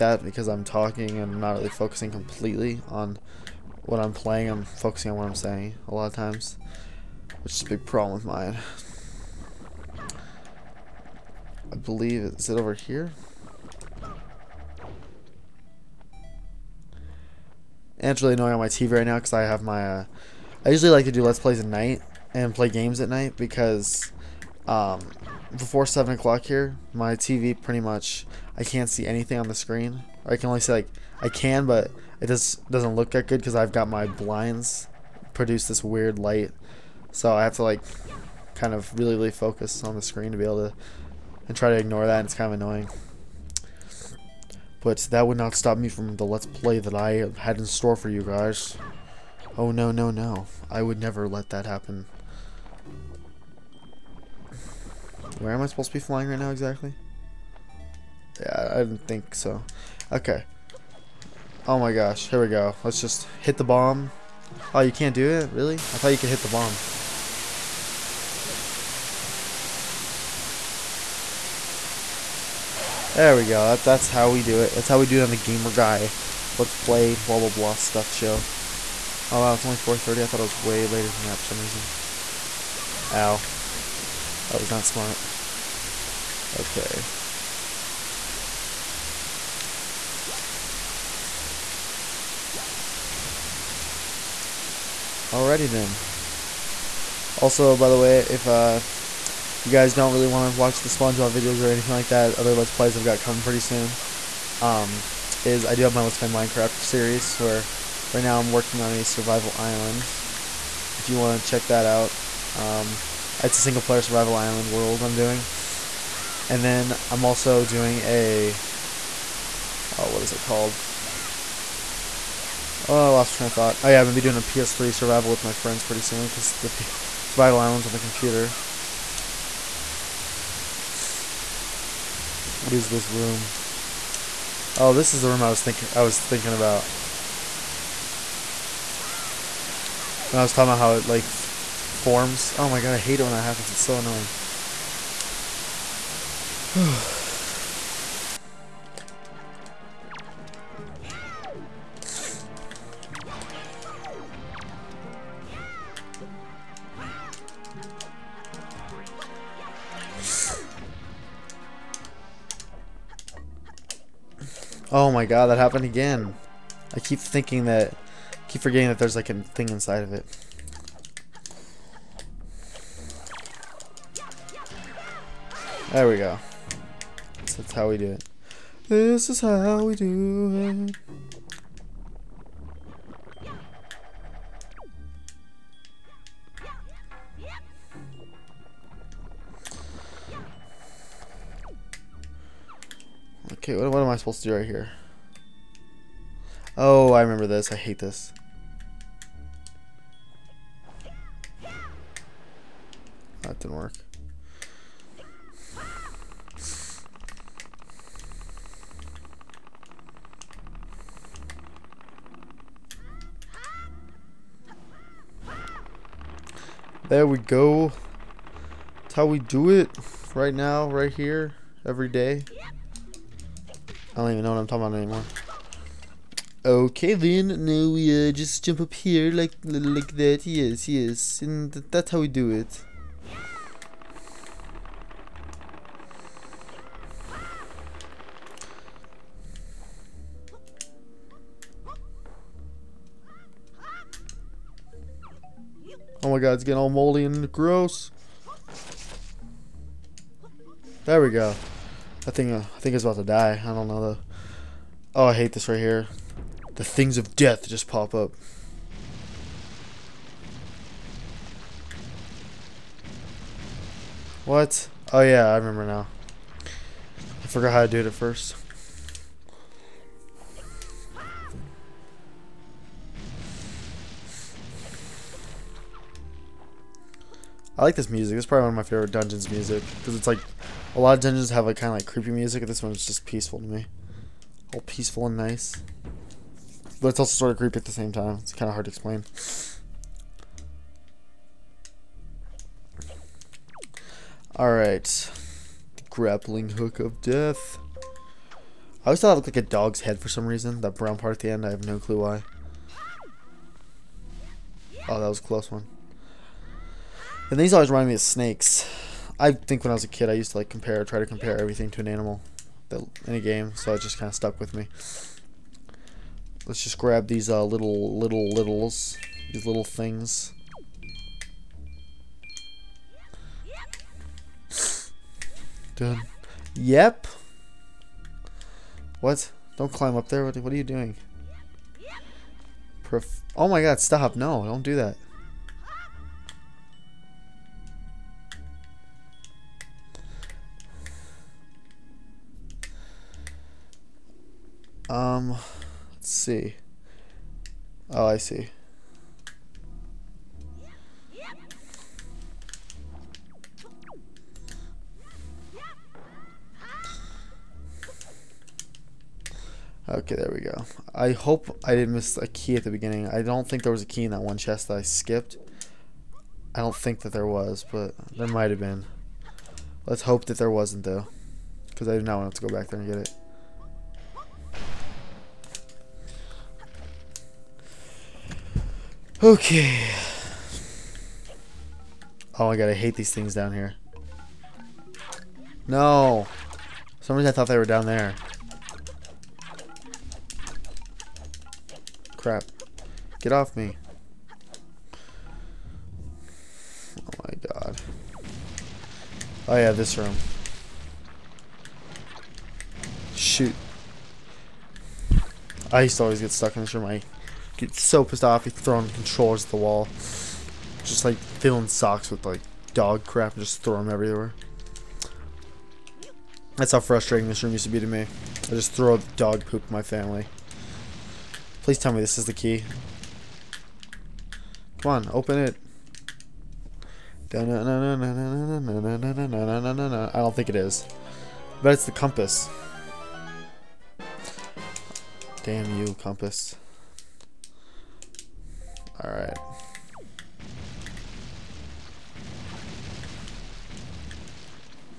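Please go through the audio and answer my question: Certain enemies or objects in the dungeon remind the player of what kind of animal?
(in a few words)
snakes.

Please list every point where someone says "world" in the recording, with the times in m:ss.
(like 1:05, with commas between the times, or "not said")
1:54.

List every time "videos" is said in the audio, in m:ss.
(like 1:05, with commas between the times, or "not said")
1:41.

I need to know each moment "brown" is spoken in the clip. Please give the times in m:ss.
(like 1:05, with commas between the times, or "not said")
5:00.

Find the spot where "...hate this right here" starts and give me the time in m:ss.
4:15.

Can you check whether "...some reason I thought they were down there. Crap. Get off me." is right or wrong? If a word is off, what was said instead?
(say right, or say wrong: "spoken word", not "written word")
right.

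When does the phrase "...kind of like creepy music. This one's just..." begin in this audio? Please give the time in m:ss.
4:41.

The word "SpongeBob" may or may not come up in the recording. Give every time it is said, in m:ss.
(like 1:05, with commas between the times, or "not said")
1:40.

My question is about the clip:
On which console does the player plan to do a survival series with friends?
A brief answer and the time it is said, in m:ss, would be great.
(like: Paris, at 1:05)
PS3, at 2:04.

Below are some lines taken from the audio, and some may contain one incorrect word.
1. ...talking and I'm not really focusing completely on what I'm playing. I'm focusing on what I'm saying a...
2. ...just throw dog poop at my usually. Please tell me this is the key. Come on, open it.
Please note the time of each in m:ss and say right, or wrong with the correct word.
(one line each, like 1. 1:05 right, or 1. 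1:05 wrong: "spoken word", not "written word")
1. 0:00 right
2. 6:58 wrong: "family", not "usually".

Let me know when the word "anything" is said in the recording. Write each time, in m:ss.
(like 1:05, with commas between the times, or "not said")
0:29, 1:41.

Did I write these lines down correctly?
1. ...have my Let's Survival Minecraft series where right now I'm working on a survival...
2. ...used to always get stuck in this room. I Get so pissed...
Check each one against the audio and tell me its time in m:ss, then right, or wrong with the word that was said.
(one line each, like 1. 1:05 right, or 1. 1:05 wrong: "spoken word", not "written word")
1. 1:45 wrong: "Play", not "Survival"
2. 6:46 right.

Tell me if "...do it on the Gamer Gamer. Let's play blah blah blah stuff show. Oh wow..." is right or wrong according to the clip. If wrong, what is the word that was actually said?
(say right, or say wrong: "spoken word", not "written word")
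wrong: "Guy", not "Gamer".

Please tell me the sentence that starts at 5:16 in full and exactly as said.
Let's just grab these uh, little, little, littles, these little things.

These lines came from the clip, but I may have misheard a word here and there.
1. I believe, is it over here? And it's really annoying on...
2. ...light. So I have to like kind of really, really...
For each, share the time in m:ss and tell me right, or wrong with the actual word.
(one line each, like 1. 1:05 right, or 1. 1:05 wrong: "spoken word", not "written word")
1. 0:11 right
2. 0:36 right.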